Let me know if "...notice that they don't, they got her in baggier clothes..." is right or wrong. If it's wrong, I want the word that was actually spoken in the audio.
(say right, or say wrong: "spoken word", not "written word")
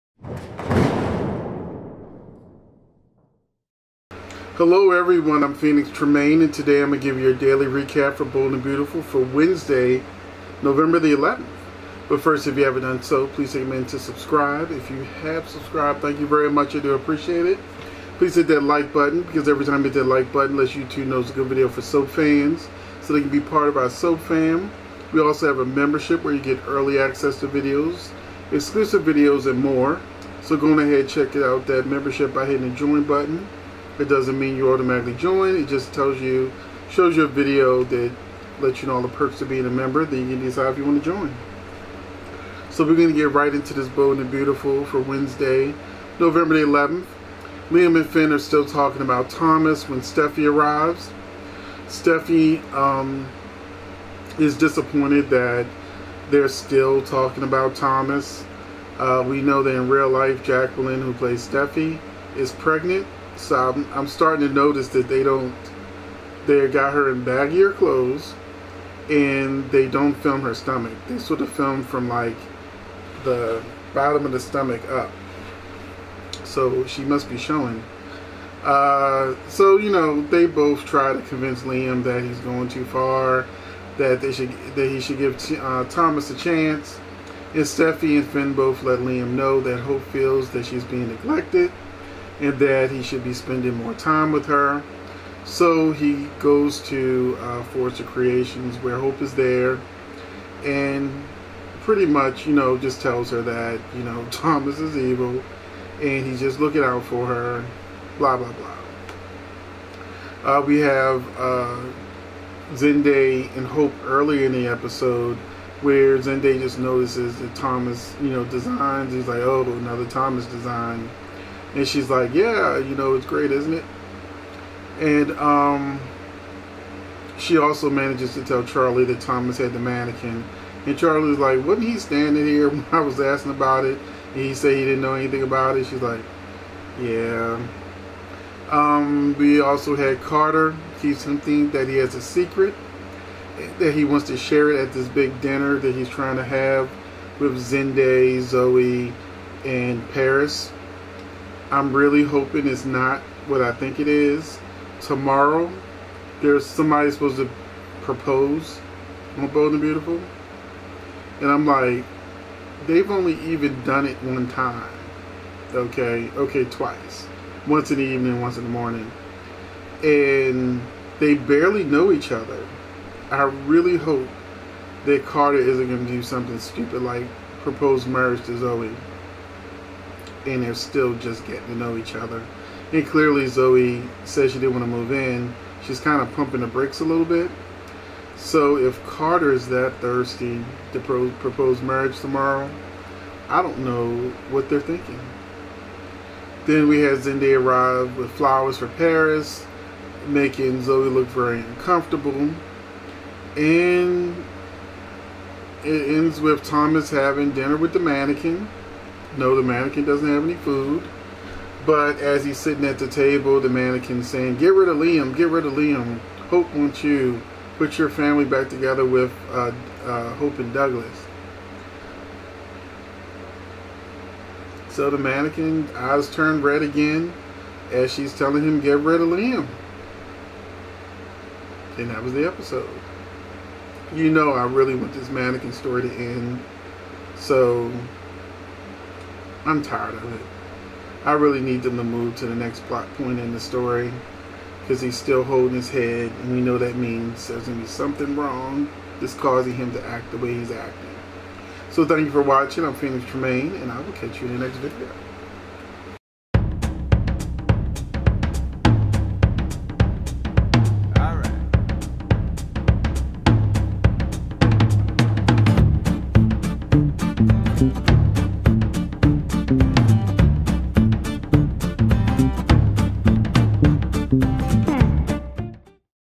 right.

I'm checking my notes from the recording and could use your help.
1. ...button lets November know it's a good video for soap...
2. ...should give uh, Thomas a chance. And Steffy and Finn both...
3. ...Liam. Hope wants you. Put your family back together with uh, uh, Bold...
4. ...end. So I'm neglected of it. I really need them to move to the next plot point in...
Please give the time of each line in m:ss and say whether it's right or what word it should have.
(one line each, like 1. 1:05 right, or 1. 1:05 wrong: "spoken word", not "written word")
1. 0:20 wrong: "YouTube", not "November"
2. 1:24 right
3. 3:35 wrong: "Hope", not "Bold"
4. 3:56 wrong: "tired", not "neglected".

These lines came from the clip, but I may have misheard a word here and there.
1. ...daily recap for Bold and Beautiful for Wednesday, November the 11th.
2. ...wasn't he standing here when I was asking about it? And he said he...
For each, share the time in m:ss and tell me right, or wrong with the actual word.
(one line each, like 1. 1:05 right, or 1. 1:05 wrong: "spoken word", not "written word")
1. 0:07 right
2. 2:11 right.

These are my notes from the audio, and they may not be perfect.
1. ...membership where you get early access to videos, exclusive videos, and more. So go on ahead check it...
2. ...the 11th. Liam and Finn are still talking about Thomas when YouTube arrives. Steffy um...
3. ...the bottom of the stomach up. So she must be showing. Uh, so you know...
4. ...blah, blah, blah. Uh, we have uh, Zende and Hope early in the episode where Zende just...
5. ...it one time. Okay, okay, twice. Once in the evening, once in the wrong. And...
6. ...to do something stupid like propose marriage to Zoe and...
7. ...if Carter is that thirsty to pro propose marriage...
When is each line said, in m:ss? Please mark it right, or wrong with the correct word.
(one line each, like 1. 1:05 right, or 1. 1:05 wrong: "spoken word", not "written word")
1. 0:25 right
2. 0:46 wrong: "Steffy", not "YouTube"
3. 1:13 right
4. 1:48 right
5. 2:44 wrong: "morning", not "wrong"
6. 2:56 right
7. 3:08 right.